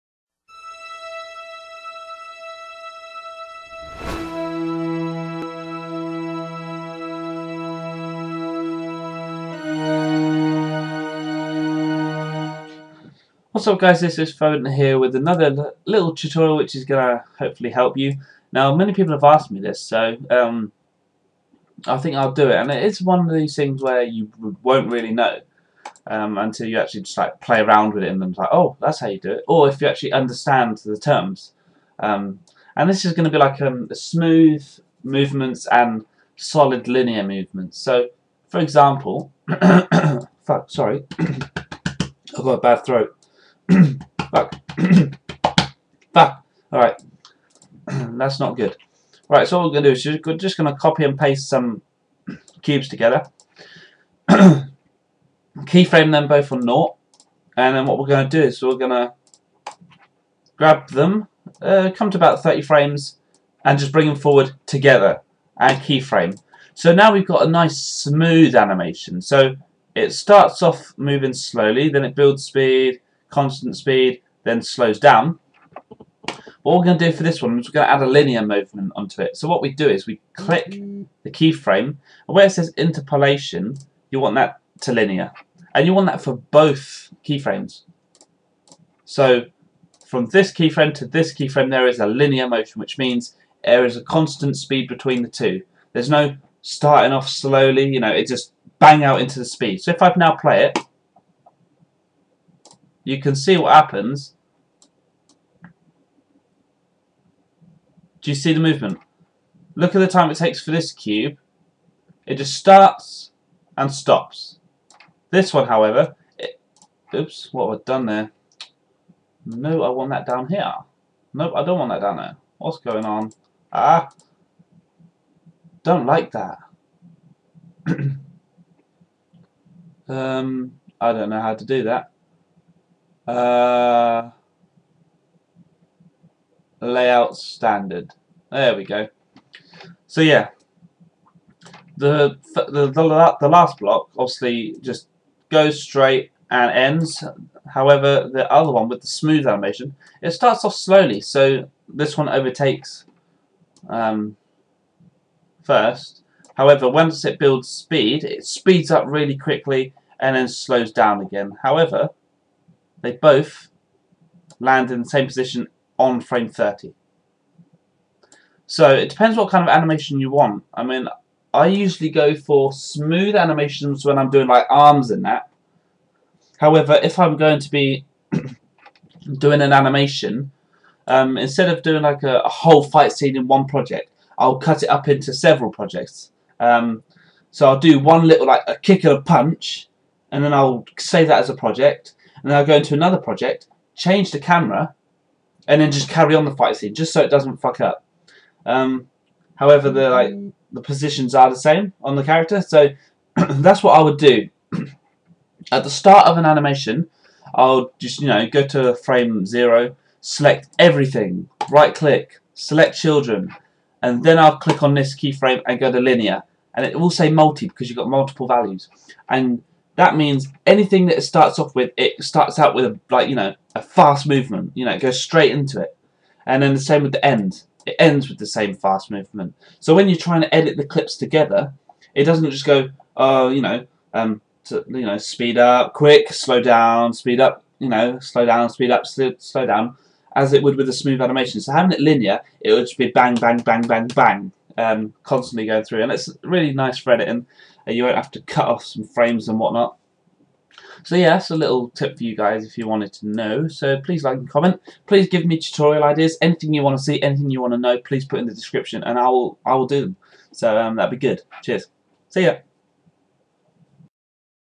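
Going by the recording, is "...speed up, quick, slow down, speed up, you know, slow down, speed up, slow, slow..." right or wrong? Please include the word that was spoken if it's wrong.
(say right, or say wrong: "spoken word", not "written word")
right.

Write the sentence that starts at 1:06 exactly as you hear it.
So now we've got a nice smooth animation.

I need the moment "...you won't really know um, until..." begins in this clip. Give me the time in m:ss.
0:24.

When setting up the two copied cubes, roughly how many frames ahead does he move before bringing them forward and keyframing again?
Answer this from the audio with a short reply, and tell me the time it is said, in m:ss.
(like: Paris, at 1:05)
30 frames, at 1:02.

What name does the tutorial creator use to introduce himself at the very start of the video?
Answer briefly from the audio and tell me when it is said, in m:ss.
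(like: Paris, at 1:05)
Foden, at 0:14.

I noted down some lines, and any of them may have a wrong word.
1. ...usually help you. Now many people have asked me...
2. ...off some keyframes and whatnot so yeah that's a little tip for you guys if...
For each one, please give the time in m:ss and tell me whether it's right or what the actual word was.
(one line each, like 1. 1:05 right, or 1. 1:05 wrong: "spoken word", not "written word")
1. 0:17 wrong: "hopefully", not "usually"
2. 4:08 wrong: "frames", not "keyframes".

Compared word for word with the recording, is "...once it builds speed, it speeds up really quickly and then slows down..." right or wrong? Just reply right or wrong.
right.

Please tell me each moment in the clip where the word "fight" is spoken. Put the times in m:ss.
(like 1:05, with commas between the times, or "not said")
3:02, 3:16.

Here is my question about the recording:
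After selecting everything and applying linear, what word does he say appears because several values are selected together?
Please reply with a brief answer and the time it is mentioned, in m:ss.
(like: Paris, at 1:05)
multi, at 3:37.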